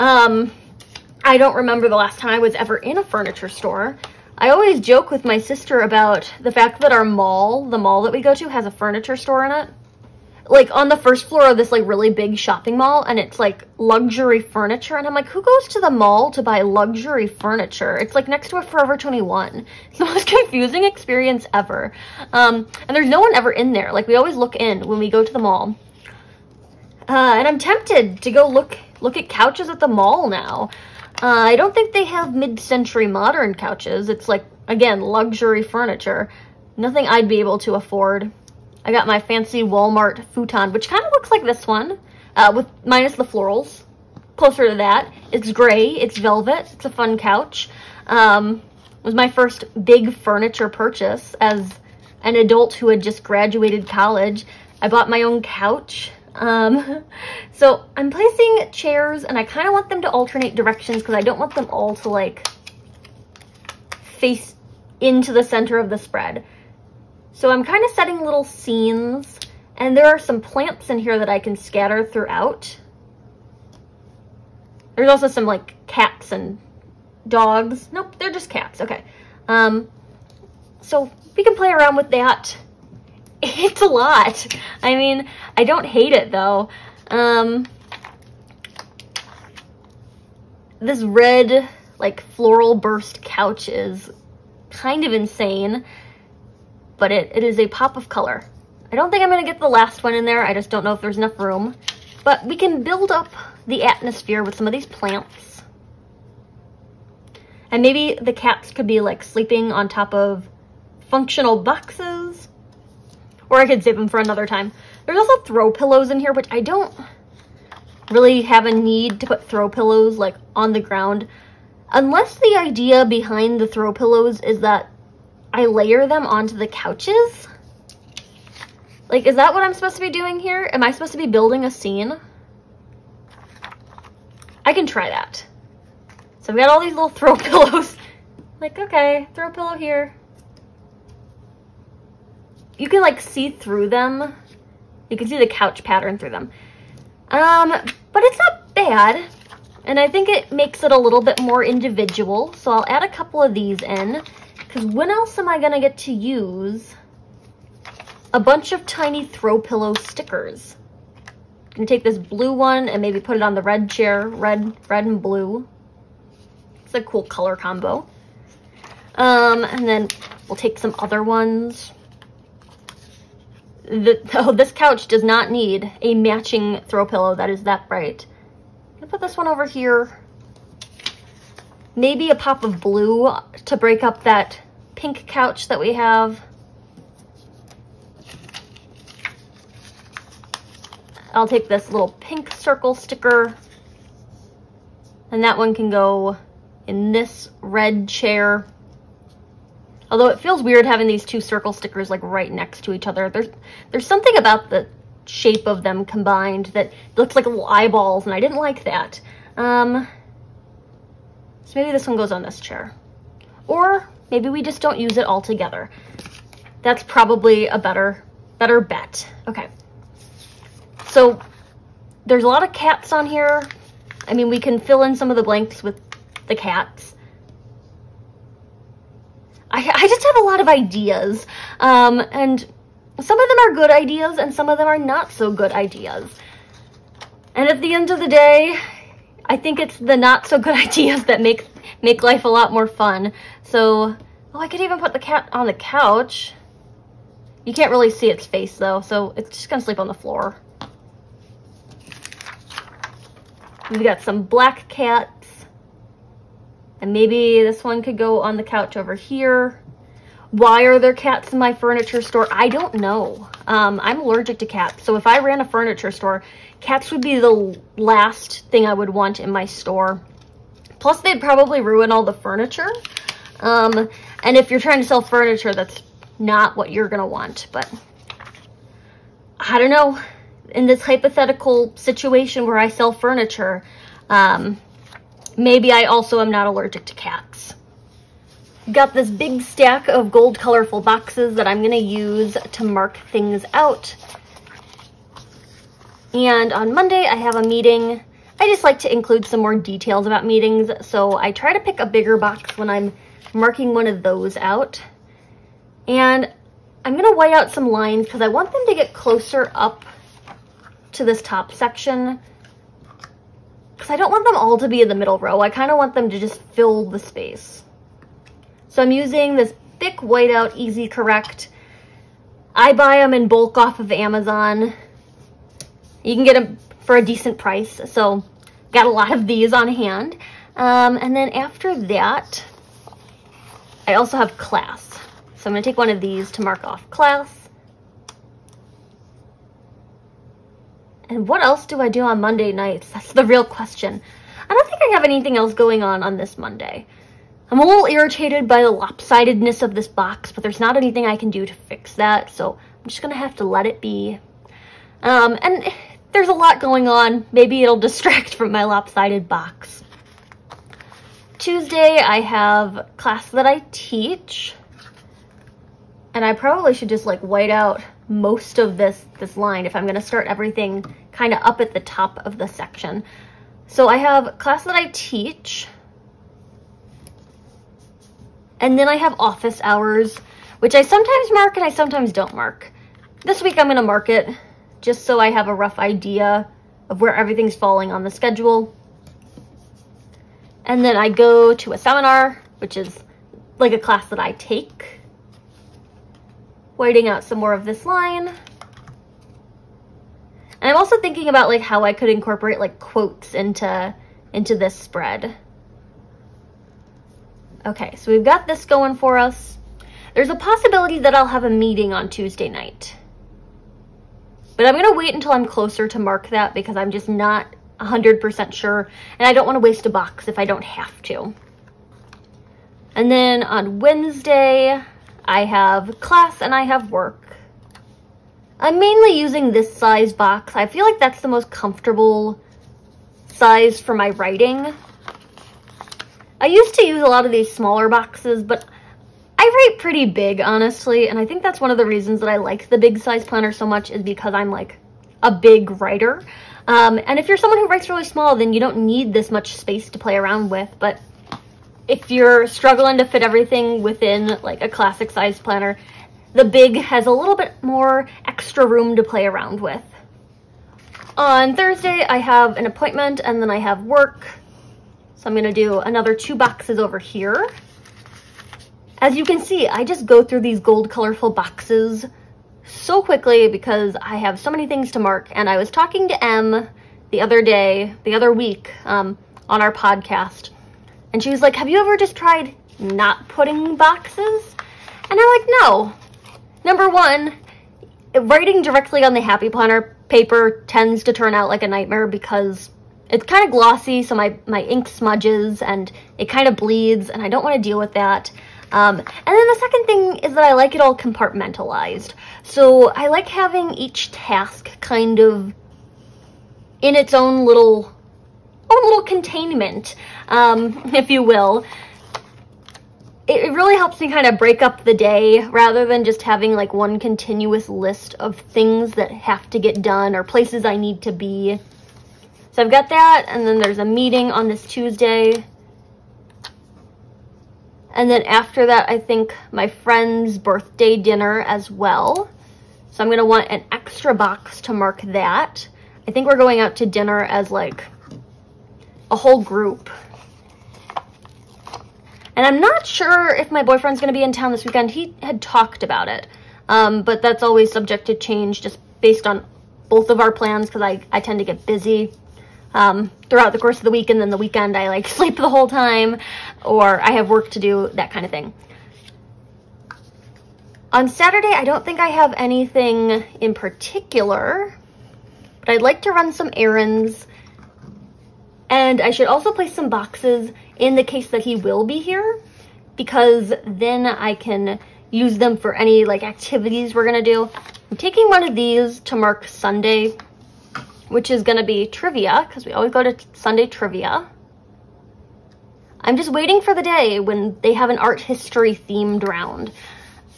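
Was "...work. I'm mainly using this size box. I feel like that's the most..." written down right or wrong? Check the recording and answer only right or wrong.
right.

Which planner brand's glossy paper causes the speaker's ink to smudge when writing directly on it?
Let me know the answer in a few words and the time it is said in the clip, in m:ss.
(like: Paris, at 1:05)
Happy Planner, at 8:09.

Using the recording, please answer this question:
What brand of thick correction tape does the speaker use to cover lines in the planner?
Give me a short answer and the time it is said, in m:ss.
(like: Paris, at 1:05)
Easy Correct, at 5:20.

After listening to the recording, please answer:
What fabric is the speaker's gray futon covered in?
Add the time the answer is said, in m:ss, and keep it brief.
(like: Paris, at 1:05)
Velvet, at 0:46.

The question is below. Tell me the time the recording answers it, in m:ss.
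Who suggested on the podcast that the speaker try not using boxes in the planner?
7:56.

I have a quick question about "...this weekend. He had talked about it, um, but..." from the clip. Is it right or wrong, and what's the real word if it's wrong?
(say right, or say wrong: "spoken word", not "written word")
right.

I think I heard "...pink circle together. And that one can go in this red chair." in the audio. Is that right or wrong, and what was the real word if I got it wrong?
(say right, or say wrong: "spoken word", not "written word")
wrong: "sticker", not "together".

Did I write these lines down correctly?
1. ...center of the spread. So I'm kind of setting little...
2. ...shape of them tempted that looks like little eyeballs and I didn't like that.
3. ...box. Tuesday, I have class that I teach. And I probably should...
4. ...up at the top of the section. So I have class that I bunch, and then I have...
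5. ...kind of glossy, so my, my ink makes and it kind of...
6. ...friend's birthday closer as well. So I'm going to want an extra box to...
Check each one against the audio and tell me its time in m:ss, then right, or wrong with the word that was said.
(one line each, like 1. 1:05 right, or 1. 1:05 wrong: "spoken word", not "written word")
1. 1:05 right
2. 3:25 wrong: "combined", not "tempted"
3. 5:59 right
4. 6:11 wrong: "teach", not "bunch"
5. 8:13 wrong: "smudges", not "makes"
6. 8:49 wrong: "dinner", not "closer".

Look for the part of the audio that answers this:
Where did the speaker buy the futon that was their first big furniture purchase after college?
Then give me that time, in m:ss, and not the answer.
0:39.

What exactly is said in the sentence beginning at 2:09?
Like, is that what I'm supposed to be doing here?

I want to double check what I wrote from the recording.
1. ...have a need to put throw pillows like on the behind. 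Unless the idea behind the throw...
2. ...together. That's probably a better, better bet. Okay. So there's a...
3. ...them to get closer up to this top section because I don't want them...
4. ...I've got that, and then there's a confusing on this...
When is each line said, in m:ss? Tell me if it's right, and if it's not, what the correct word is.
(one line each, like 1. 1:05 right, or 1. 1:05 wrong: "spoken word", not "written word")
1. 1:58 wrong: "ground", not "behind"
2. 3:35 right
3. 5:08 right
4. 8:42 wrong: "meeting", not "confusing".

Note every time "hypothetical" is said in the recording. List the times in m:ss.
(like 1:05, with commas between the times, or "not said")
4:40.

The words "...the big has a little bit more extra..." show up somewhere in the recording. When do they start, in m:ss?
7:36.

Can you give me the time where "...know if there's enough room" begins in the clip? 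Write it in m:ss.
1:40.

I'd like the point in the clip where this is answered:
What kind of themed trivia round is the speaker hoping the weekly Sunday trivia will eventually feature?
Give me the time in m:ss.
9:48.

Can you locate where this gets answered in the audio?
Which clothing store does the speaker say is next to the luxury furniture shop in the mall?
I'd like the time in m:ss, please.
0:18.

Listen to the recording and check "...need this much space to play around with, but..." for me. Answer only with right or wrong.
right.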